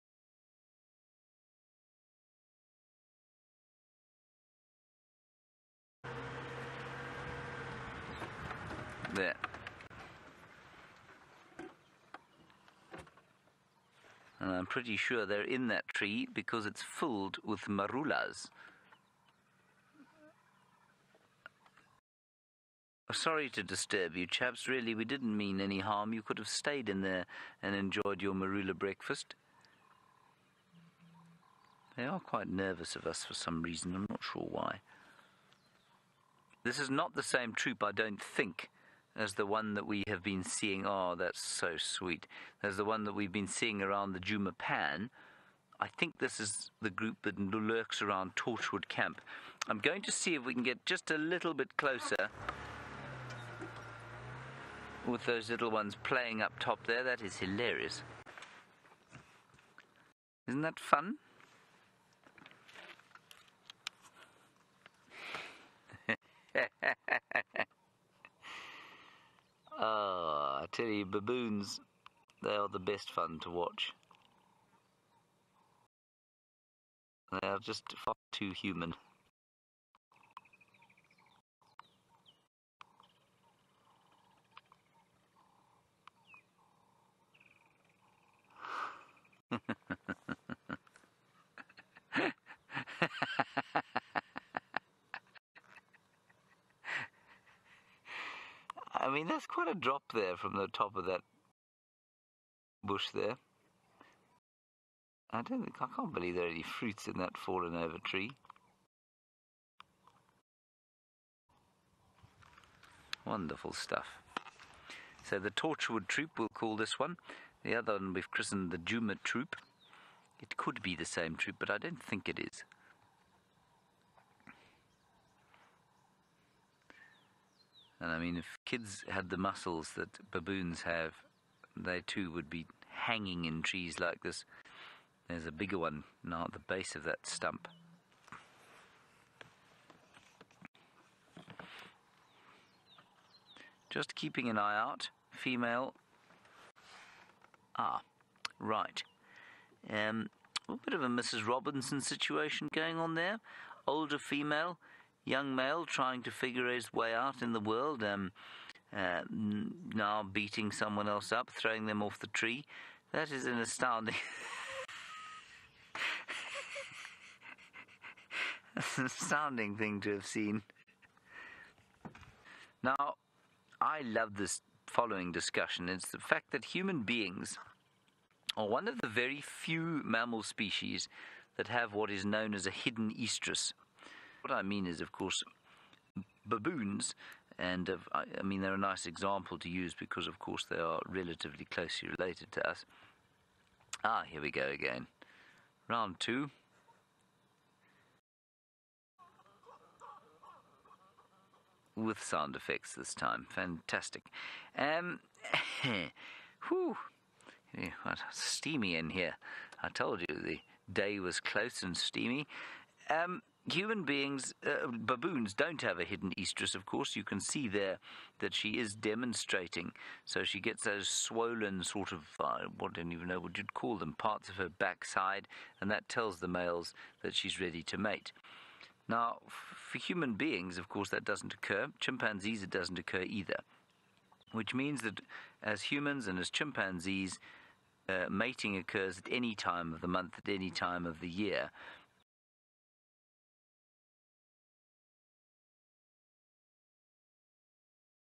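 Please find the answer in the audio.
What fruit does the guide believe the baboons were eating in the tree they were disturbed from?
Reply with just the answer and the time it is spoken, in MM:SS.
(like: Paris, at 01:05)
Marulas, at 00:17.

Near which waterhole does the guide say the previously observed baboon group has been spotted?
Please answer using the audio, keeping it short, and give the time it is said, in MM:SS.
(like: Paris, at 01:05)
Djuma Pan, at 00:44.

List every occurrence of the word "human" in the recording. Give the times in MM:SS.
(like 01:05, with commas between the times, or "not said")
01:18, 02:56, 03:33, 03:49, 03:55.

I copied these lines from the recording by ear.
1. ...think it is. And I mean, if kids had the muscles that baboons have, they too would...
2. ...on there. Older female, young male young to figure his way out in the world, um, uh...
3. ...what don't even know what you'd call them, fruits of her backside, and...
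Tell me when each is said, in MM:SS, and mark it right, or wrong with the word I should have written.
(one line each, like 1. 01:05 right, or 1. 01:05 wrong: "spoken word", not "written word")
1. 02:02 right
2. 02:32 wrong: "trying", not "young"
3. 03:42 wrong: "parts", not "fruits".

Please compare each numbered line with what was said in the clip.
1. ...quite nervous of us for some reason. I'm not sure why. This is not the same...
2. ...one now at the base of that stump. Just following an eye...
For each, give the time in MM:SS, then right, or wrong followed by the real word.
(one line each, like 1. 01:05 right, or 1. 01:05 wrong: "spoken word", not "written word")
1. 00:32 right
2. 02:15 wrong: "keeping", not "following".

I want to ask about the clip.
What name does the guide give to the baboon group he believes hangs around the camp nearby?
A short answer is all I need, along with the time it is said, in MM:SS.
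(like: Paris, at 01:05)
Torchwood Troop, at 01:55.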